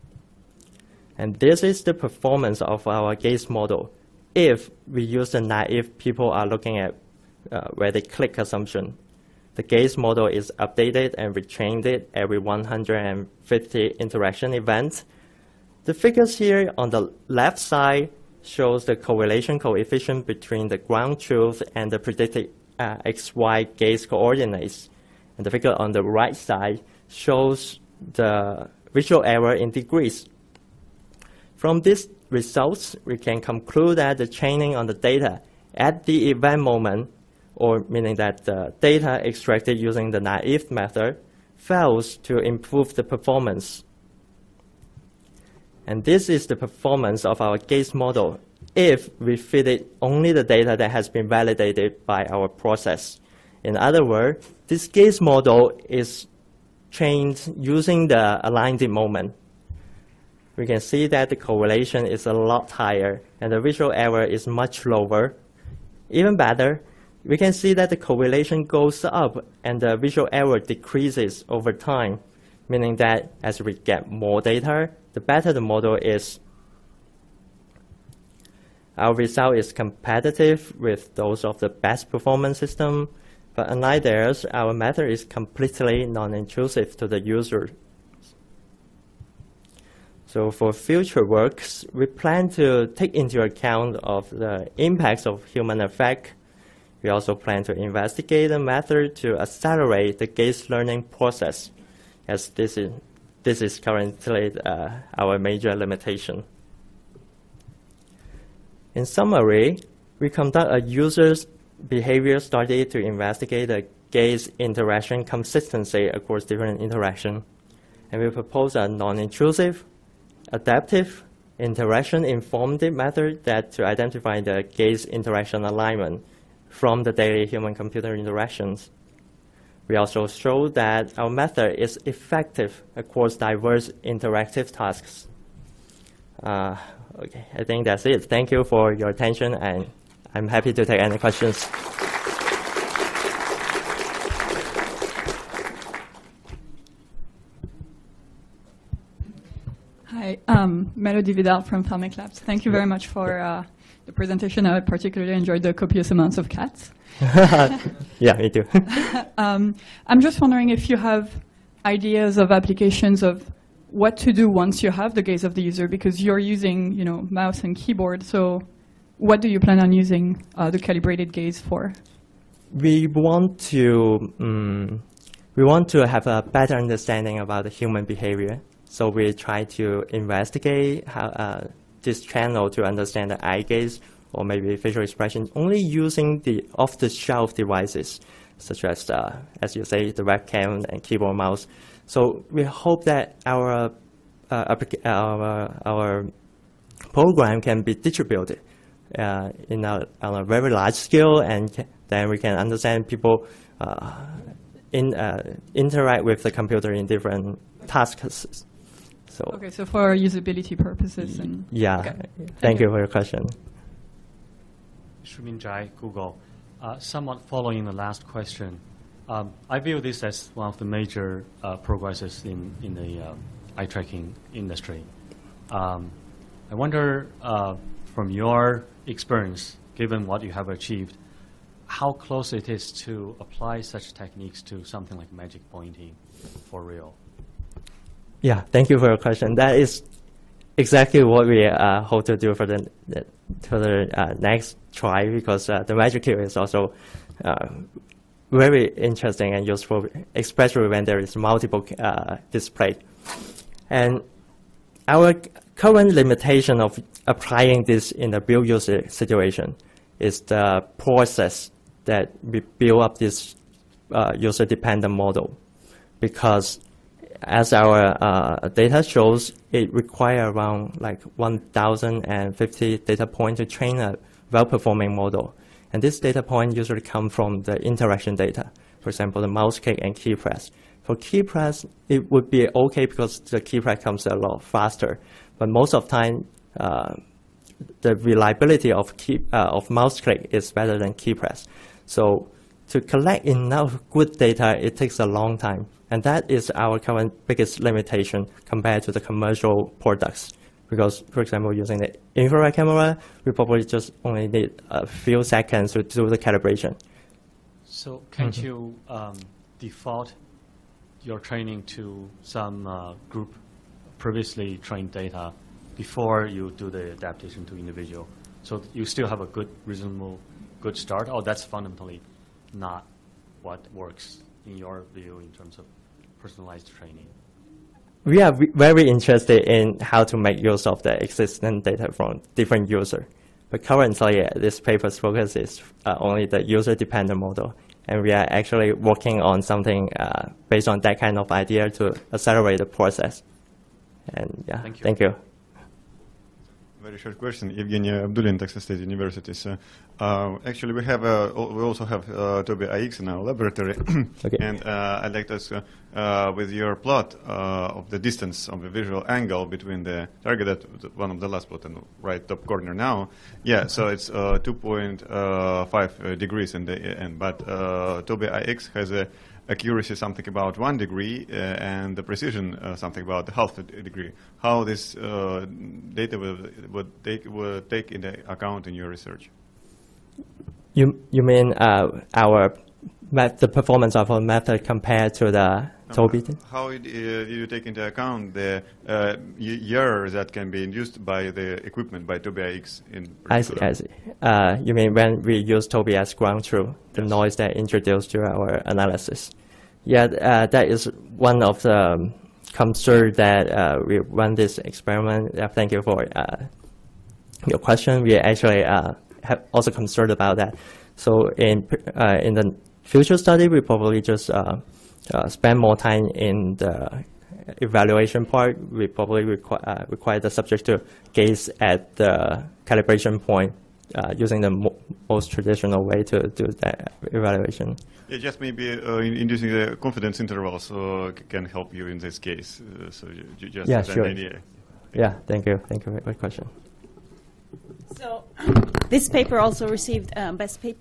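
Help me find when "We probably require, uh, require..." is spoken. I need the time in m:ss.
6:58.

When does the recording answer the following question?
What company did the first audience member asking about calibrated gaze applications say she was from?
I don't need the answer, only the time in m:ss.
2:31.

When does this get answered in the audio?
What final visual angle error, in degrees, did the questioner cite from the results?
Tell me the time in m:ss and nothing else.
6:04.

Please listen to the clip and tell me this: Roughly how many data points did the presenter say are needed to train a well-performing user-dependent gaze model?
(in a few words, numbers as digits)
1,050.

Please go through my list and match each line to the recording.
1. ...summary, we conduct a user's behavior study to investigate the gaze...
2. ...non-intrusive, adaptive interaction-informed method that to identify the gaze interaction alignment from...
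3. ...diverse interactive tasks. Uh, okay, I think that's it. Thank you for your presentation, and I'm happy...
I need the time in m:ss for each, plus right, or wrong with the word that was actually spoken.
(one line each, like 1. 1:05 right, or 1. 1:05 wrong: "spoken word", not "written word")
1. 1:49 right
2. 1:58 right
3. 2:13 wrong: "attention", not "presentation".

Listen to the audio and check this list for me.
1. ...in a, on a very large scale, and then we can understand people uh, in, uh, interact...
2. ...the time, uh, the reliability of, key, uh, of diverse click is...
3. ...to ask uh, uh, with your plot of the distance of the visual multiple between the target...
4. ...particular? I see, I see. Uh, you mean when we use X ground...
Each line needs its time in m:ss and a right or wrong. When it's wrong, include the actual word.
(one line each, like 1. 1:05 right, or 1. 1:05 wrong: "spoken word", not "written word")
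1. 3:19 right
2. 4:46 wrong: "mouse", not "diverse"
3. 5:55 wrong: "angle", not "multiple"
4. 6:33 right.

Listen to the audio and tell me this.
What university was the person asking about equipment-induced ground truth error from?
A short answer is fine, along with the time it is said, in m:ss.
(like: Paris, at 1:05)
Texas State University, at 5:48.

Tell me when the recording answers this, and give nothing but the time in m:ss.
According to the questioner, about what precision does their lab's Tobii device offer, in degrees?
6:13.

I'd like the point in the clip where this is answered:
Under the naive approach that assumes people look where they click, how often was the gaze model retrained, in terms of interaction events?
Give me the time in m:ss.
0:12.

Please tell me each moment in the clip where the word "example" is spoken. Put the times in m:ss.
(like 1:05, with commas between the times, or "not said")
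4:39, 5:01.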